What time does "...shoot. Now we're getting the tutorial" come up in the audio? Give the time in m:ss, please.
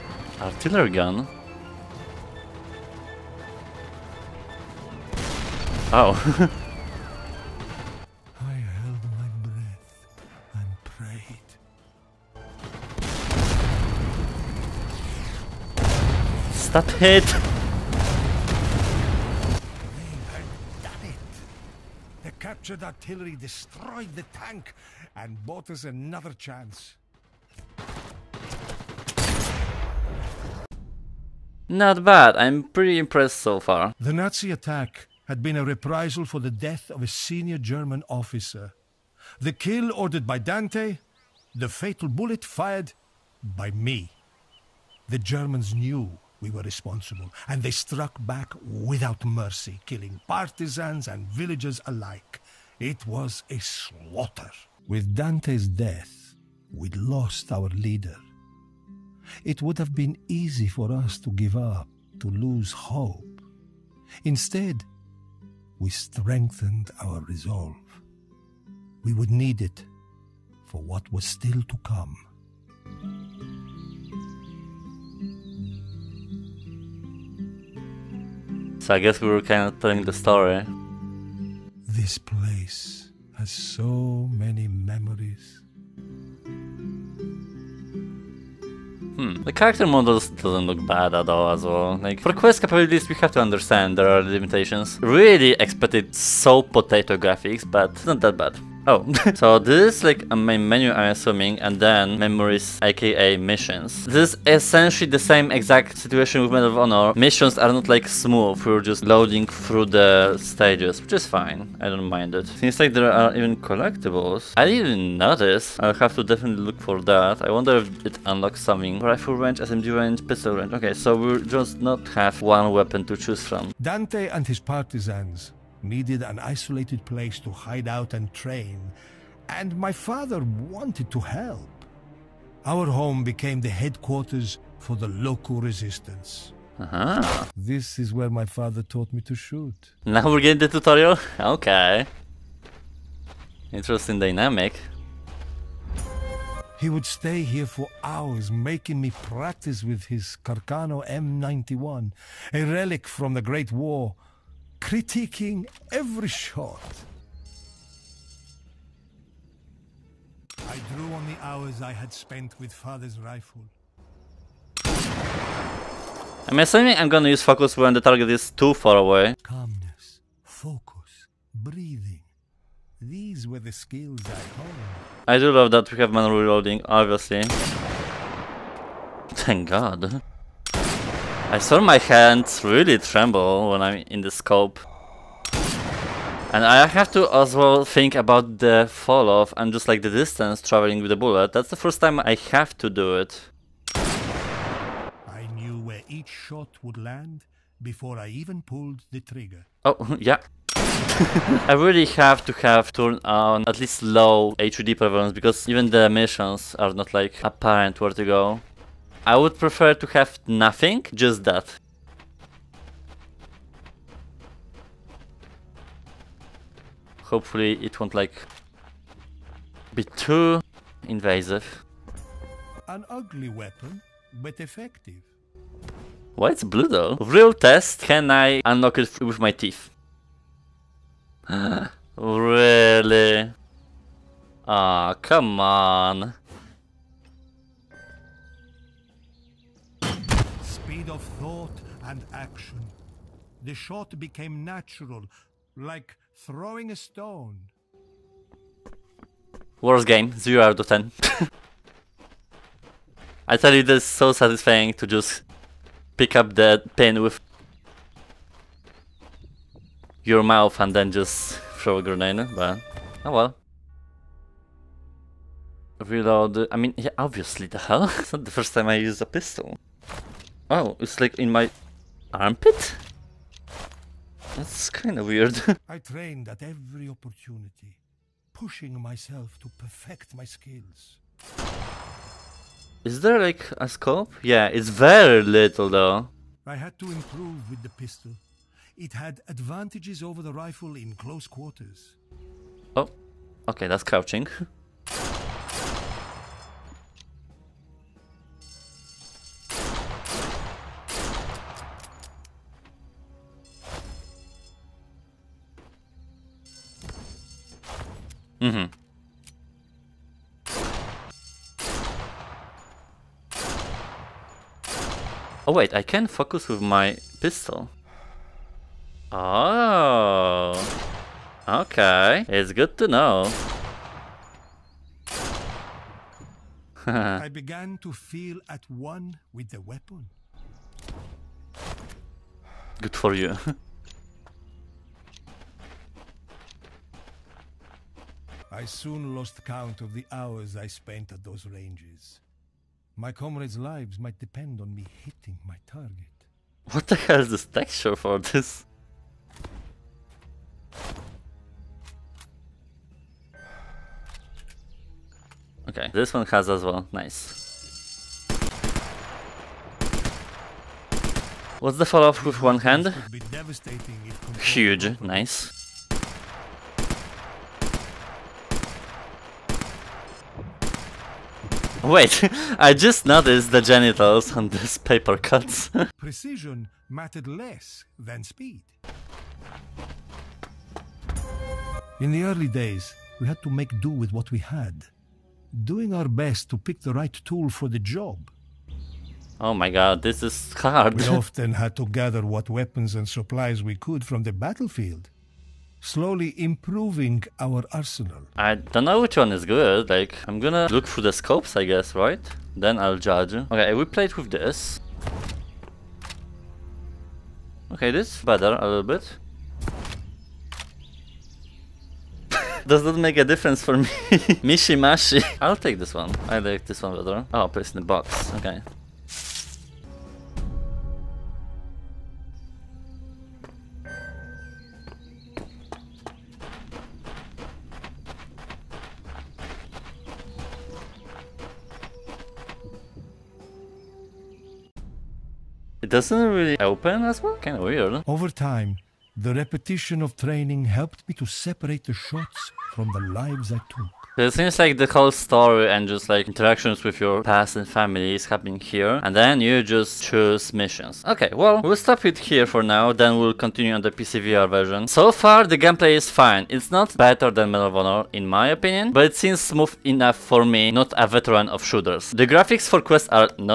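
2:19.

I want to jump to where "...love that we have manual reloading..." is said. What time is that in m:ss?
2:55.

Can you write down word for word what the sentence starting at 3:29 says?
I would prefer to have nothing, just that.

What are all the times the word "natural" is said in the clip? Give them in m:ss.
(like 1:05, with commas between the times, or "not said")
4:04.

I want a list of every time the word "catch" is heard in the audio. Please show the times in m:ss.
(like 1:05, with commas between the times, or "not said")
not said.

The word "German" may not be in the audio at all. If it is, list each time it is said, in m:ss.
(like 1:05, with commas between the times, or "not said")
0:37, 0:45.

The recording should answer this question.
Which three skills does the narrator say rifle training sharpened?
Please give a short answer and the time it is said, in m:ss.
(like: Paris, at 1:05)
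Calmness, focus, breathing, at 2:49.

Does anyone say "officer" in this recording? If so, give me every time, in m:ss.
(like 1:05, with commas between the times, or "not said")
0:38.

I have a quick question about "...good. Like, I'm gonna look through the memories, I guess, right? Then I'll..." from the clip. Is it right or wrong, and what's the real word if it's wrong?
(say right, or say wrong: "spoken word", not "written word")
wrong: "scopes", not "memories".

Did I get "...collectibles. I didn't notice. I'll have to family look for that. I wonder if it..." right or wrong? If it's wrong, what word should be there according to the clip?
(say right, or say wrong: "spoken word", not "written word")
wrong: "definitely", not "family".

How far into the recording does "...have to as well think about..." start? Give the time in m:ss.
3:06.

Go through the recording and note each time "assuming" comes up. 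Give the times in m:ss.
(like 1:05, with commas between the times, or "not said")
1:41, 2:46.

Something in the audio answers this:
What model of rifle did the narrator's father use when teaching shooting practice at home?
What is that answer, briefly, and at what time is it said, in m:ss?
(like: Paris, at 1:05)
Carcano M91, at 2:30.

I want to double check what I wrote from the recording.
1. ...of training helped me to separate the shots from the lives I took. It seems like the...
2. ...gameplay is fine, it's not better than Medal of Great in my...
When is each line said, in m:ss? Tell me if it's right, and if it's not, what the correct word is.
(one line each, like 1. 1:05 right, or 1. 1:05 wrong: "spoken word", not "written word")
1. 7:20 right
2. 7:35 wrong: "Honor", not "Great".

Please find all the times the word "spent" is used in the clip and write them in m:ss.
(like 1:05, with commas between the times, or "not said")
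2:42, 5:40.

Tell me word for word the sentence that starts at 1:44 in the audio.
This is essentially the same exact situation with Medal of Honor.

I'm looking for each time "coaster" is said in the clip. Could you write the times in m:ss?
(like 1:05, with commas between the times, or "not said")
not said.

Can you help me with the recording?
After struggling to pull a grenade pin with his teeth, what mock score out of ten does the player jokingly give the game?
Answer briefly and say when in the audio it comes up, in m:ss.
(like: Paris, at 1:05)
0 out of 10, at 4:10.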